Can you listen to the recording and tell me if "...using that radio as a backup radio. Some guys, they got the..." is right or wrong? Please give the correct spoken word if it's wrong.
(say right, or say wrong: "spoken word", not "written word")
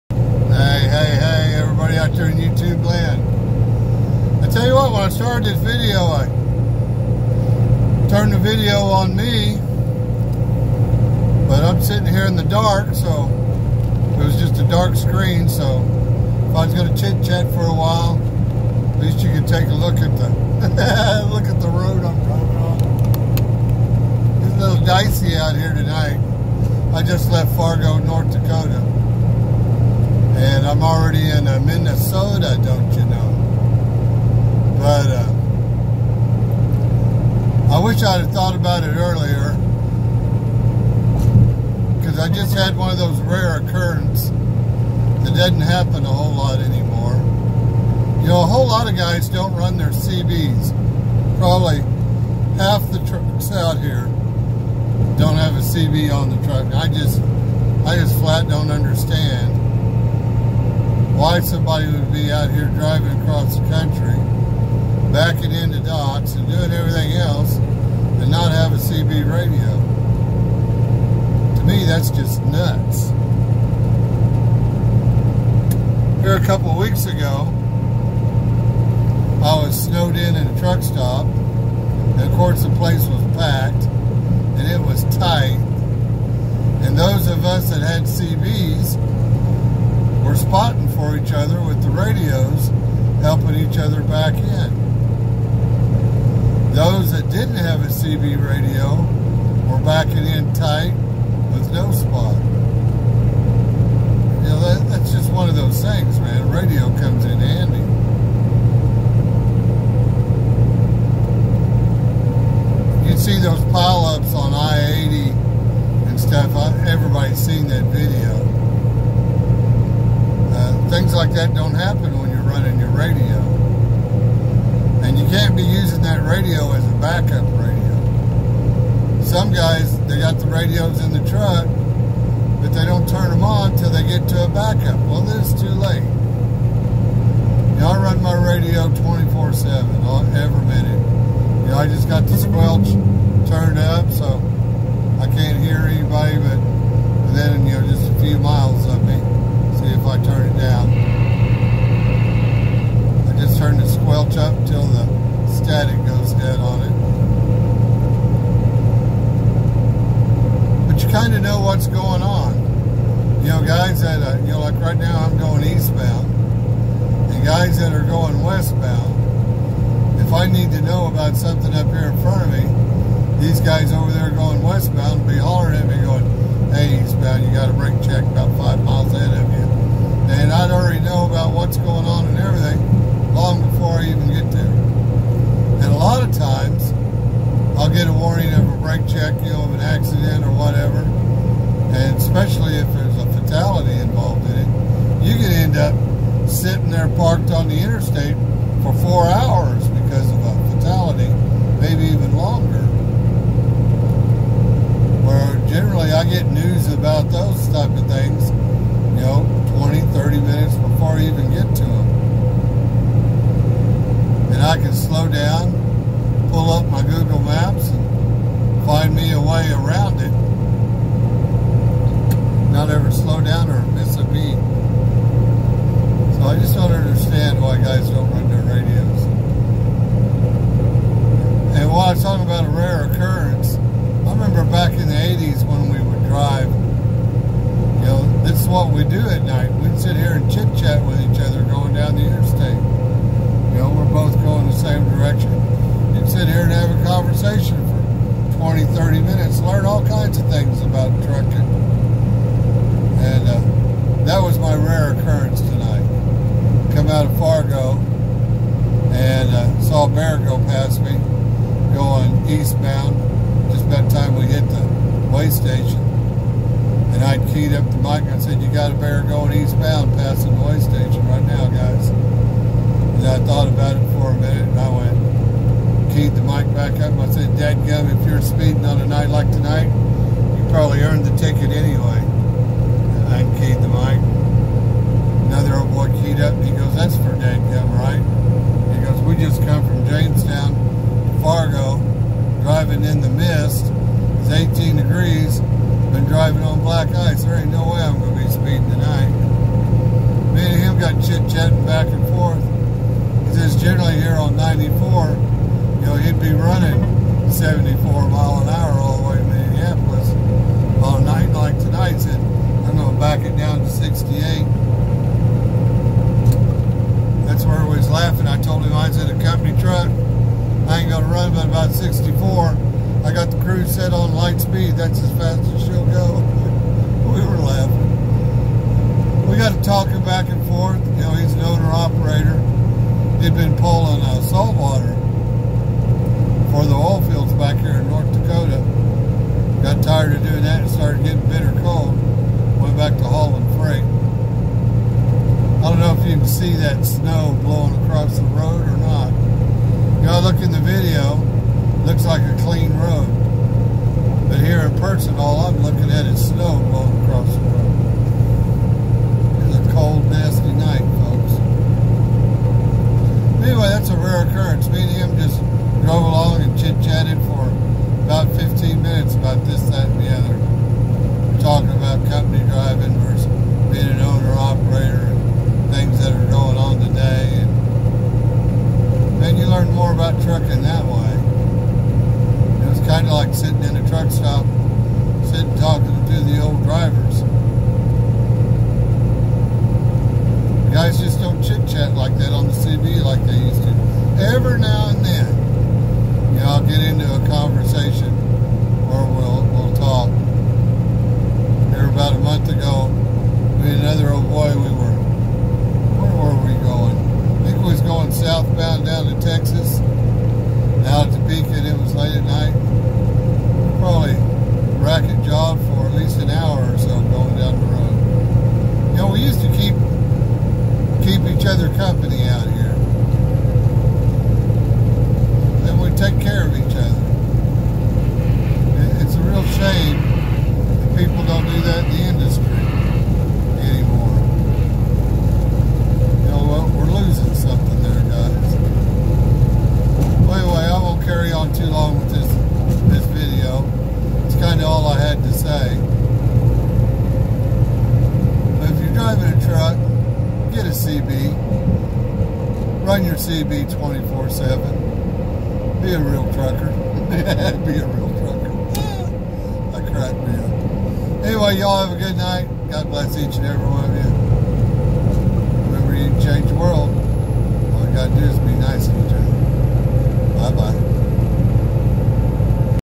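right.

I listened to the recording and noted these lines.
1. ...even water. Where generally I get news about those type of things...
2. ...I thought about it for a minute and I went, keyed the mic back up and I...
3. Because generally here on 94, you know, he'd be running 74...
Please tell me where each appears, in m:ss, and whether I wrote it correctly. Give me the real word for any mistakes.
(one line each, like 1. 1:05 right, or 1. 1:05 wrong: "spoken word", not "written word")
1. 3:22 wrong: "longer", not "water"
2. 4:33 right
3. 5:03 right.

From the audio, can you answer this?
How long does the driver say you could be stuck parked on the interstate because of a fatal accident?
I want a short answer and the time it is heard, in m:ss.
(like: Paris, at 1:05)
4 hours, at 3:19.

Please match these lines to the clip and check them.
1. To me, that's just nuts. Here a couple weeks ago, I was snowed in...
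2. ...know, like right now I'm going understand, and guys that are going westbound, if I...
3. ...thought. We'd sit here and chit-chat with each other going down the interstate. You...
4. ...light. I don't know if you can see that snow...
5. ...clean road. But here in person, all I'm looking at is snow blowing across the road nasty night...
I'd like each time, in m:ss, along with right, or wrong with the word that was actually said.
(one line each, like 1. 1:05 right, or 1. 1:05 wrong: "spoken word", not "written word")
1. 1:11 right
2. 2:44 wrong: "eastbound", not "understand"
3. 3:59 wrong: "night", not "thought"
4. 5:43 wrong: "freight", not "light"
5. 5:52 right.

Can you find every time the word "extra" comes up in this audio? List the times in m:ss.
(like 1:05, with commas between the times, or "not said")
not said.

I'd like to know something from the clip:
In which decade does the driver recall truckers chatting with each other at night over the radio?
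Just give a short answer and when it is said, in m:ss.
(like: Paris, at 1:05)
1980s, at 3:55.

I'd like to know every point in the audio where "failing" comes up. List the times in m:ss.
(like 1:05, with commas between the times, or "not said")
not said.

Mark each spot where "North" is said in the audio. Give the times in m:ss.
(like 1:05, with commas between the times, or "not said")
0:27, 5:38.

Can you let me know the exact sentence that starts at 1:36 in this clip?
Those that didn't have a CB radio were backing in tight with no spot.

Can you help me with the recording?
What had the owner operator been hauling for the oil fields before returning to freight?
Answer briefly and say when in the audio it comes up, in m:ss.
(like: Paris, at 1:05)
Salt water, at 5:34.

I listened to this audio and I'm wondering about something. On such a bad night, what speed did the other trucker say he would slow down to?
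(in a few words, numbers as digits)
68.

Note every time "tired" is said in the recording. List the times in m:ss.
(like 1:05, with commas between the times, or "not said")
5:40.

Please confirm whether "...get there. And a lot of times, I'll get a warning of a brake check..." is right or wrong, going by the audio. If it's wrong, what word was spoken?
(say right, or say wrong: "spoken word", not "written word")
right.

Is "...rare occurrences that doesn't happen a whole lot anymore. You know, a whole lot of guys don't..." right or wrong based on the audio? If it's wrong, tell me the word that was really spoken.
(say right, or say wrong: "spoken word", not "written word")
right.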